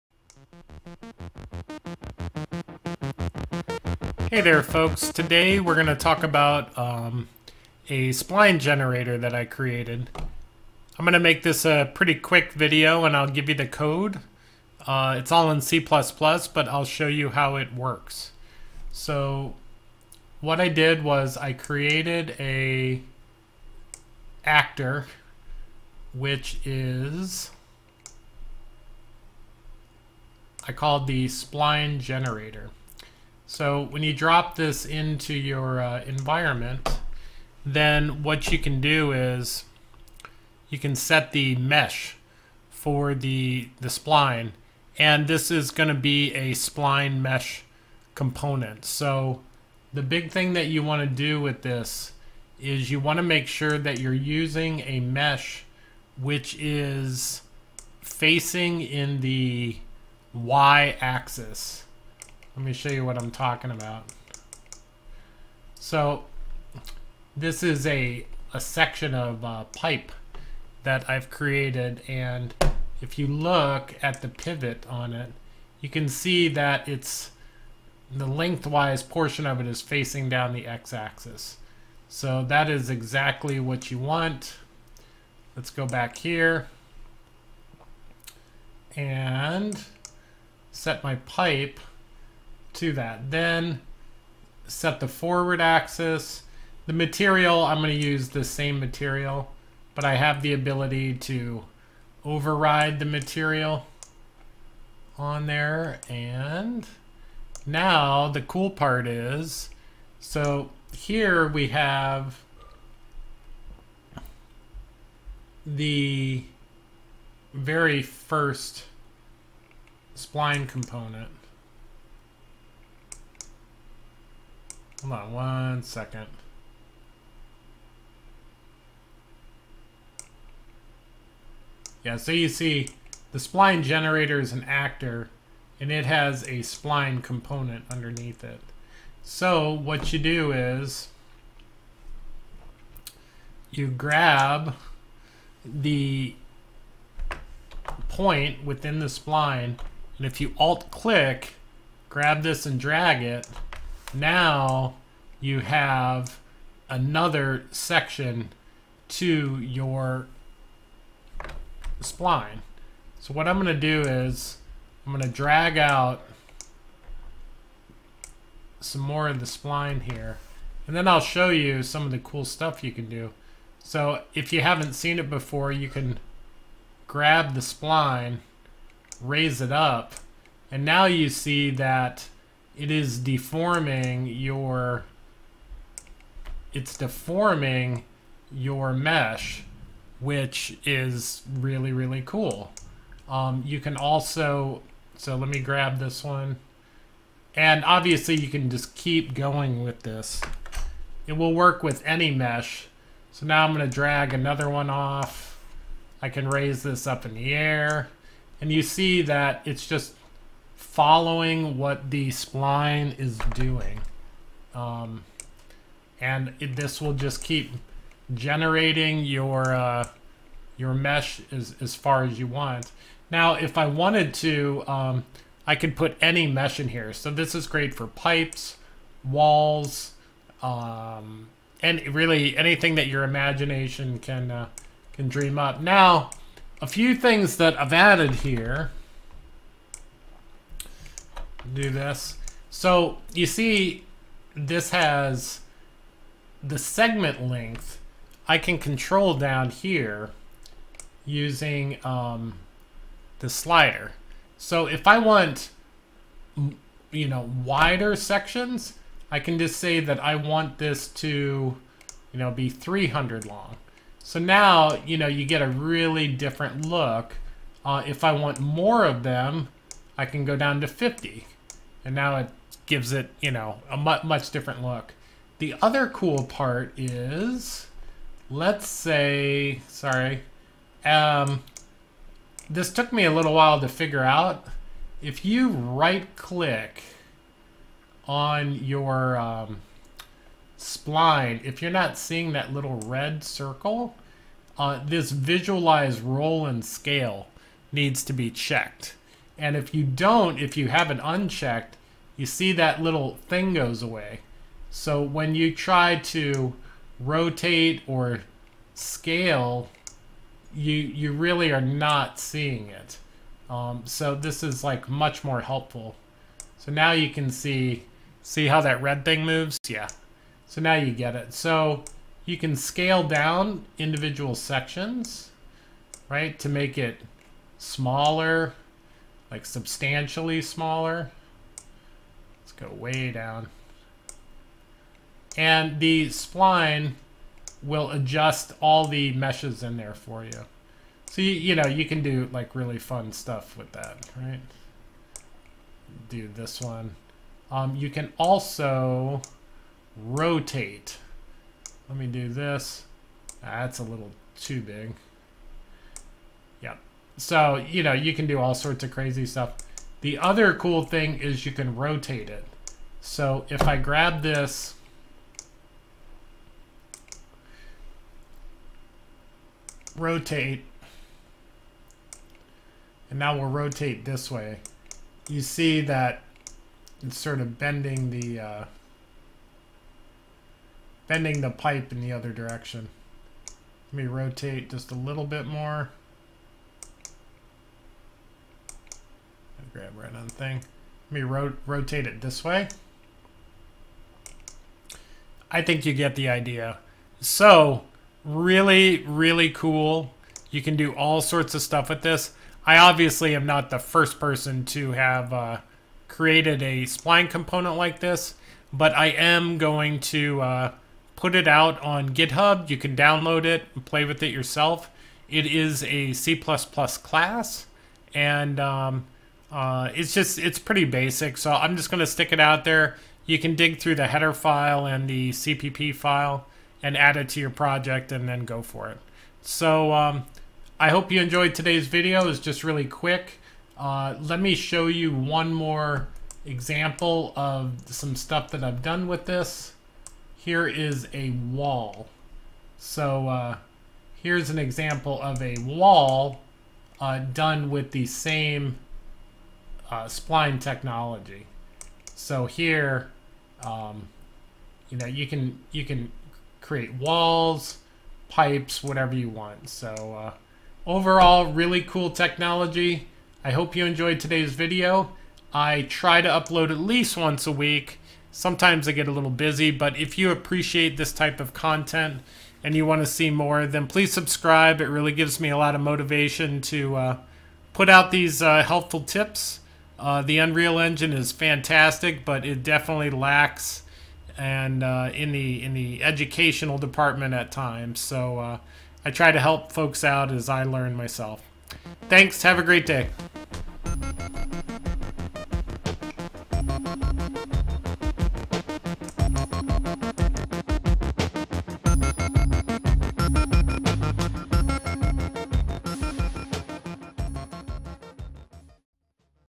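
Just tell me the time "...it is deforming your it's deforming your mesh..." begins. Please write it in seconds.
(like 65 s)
182 s.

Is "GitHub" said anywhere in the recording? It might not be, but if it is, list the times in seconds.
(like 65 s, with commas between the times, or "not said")
412 s.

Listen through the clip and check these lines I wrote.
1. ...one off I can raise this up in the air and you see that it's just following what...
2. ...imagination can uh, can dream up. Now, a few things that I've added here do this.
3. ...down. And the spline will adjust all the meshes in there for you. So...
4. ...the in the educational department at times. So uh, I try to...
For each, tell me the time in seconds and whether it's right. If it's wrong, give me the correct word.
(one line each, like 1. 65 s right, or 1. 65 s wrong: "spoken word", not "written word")
1. 204 s right
2. 233 s right
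3. 333 s right
4. 485 s right.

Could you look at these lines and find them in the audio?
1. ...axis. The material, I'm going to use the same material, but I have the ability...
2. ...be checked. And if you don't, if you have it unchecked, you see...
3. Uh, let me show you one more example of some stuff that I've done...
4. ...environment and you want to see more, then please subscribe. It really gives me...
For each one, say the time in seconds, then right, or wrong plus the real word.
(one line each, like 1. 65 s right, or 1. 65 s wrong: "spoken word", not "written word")
1. 95 s right
2. 298 s right
3. 433 s right
4. 471 s wrong: "content", not "environment".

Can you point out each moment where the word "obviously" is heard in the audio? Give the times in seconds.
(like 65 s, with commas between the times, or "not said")
197 s, 402 s.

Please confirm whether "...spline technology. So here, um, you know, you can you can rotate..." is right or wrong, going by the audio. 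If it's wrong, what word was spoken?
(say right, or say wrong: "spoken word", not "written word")
wrong: "create", not "rotate".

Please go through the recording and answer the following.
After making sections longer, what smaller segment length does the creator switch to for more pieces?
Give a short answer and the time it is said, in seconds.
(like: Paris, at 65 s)
50, at 270 s.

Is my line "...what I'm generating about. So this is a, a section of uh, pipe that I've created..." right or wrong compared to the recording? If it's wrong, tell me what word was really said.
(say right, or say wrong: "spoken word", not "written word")
wrong: "talking", not "generating".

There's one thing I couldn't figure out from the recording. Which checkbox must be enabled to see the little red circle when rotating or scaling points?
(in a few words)
visualize roll and scale.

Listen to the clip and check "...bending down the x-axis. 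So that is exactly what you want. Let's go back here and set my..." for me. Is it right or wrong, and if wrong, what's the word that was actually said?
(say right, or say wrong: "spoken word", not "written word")
wrong: "facing", not "bending".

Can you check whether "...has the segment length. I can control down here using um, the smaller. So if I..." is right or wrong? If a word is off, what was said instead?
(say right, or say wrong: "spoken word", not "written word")
wrong: "slider", not "smaller".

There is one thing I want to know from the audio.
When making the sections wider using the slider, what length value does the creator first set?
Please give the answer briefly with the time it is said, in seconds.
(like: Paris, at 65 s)
300, at 262 s.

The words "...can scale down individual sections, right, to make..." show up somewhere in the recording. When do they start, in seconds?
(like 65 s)
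322 s.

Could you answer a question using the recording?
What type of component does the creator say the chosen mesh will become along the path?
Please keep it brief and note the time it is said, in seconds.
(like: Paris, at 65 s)
spline mesh component, at 46 s.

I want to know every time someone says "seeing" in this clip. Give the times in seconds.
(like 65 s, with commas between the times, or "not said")
292 s, 312 s.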